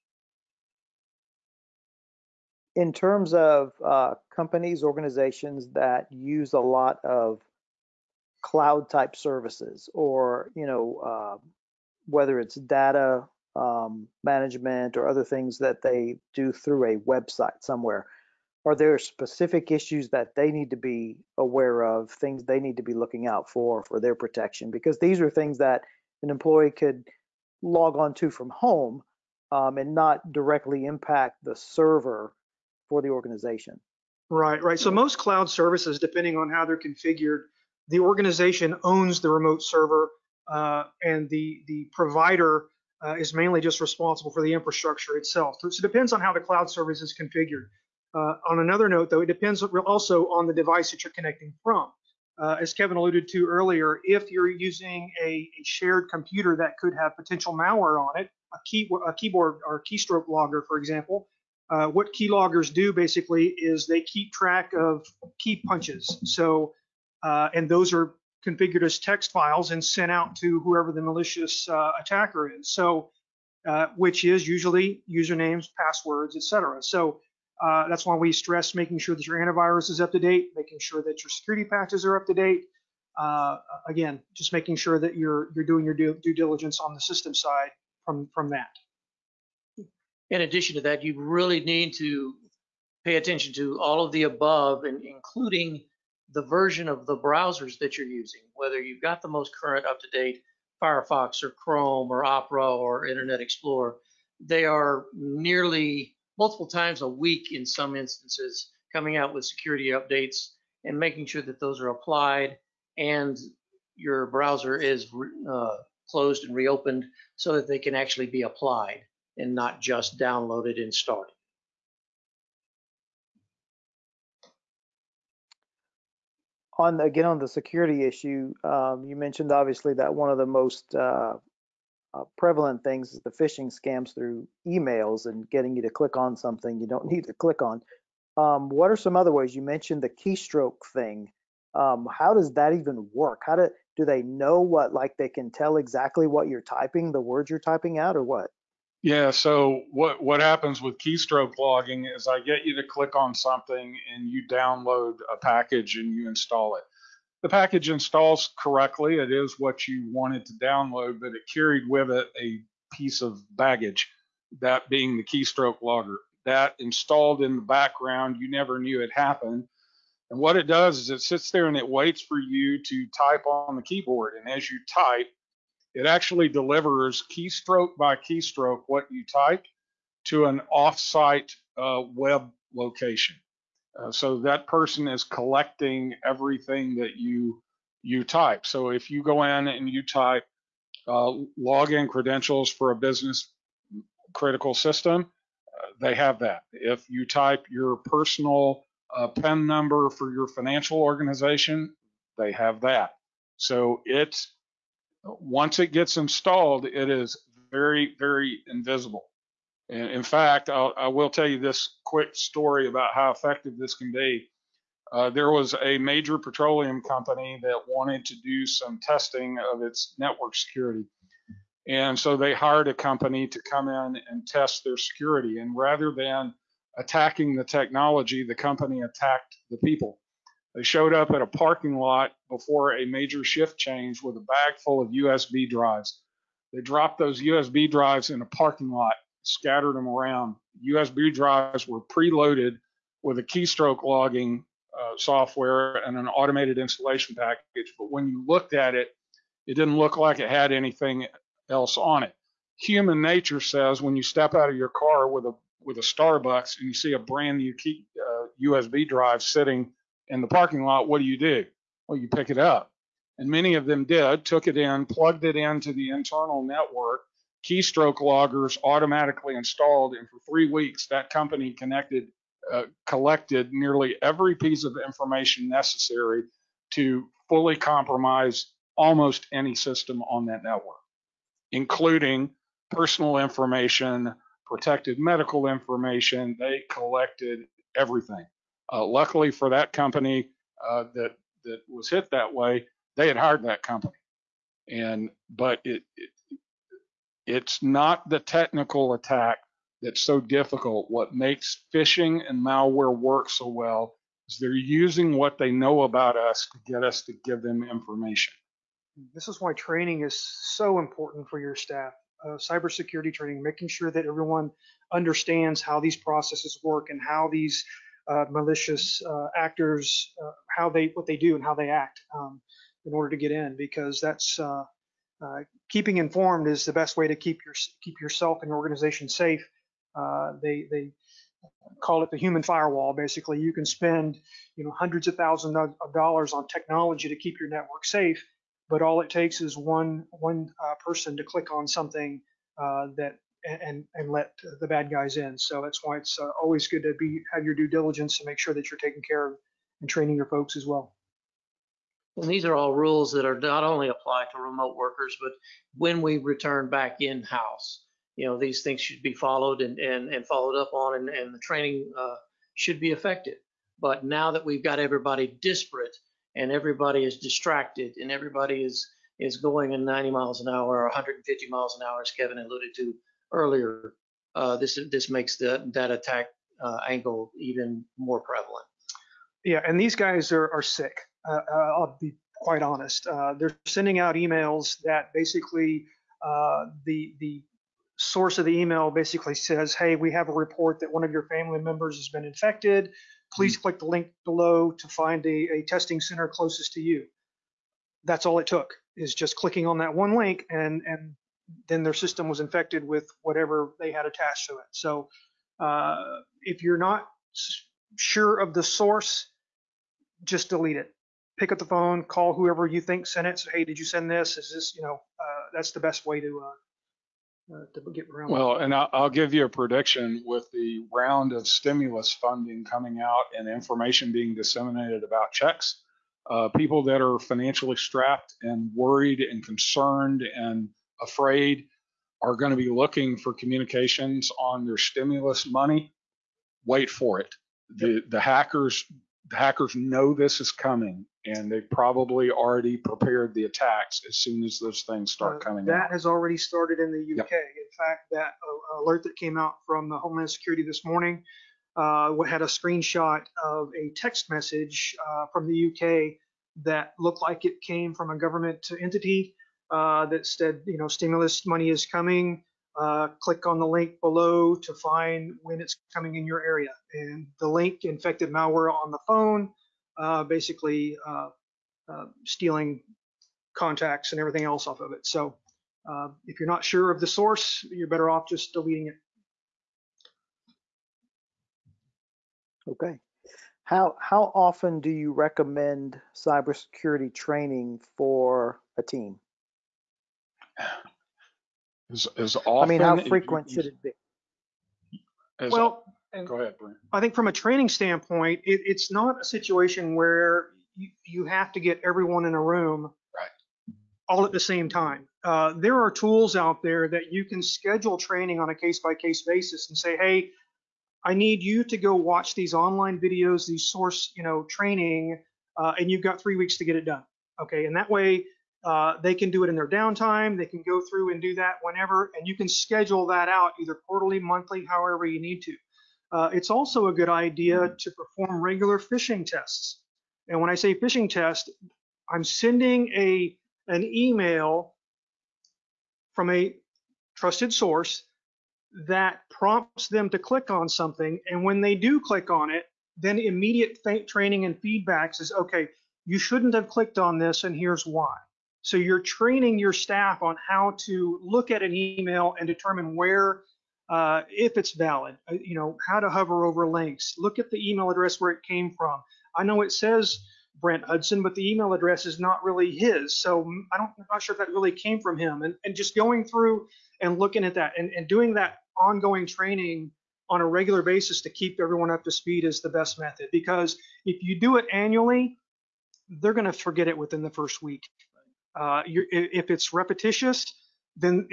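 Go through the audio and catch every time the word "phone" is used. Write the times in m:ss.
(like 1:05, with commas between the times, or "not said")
6:51, 7:49.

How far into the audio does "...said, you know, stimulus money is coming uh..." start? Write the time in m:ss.
7:40.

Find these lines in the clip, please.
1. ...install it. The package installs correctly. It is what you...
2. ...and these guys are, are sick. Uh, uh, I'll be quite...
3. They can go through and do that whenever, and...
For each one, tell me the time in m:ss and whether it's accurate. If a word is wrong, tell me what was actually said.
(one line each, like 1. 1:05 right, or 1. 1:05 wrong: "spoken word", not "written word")
1. 2:36 right
2. 6:19 right
3. 8:40 right.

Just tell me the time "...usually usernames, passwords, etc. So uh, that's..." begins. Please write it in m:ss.
1:14.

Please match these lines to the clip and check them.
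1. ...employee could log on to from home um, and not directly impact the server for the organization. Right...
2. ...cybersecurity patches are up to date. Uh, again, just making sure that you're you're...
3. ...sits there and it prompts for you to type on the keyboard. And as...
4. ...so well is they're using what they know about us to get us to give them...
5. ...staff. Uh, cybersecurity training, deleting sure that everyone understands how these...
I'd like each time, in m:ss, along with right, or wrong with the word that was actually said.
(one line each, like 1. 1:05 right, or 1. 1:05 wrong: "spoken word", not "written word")
1. 0:26 right
2. 1:21 wrong: "security", not "cybersecurity"
3. 2:51 wrong: "waits", not "prompts"
4. 5:03 right
5. 5:11 wrong: "making", not "deleting".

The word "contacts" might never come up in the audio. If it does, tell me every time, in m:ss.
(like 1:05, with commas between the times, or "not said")
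7:53.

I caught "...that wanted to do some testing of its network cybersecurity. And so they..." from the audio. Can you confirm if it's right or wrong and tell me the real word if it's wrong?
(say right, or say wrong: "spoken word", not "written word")
wrong: "security", not "cybersecurity".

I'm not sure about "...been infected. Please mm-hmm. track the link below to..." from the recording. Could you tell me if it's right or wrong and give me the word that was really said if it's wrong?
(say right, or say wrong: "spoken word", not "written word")
wrong: "click", not "track".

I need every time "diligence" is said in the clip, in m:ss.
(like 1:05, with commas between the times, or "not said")
1:26, 5:47.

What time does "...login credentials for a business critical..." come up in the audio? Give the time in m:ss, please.
3:11.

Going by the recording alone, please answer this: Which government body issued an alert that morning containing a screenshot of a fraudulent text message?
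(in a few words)
Homeland Security.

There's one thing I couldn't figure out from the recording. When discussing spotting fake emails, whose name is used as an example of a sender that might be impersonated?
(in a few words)
Brent Hudson.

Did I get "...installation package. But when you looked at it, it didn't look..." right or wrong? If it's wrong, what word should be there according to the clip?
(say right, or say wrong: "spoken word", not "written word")
right.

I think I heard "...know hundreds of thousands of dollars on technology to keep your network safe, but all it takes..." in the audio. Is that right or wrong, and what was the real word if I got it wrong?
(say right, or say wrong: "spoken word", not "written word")
right.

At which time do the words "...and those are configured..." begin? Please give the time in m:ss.
1:07.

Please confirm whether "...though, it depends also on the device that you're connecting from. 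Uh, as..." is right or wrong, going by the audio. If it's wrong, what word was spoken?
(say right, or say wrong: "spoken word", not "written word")
right.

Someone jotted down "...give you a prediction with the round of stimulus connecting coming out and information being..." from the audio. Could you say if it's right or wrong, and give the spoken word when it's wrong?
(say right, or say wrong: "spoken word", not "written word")
wrong: "funding", not "connecting".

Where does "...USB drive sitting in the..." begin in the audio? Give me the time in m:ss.
4:18.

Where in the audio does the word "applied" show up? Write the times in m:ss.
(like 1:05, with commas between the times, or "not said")
1:51, 1:58, 5:54.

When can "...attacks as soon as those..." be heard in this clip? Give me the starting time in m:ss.
7:23.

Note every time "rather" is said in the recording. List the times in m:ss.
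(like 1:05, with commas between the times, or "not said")
3:45.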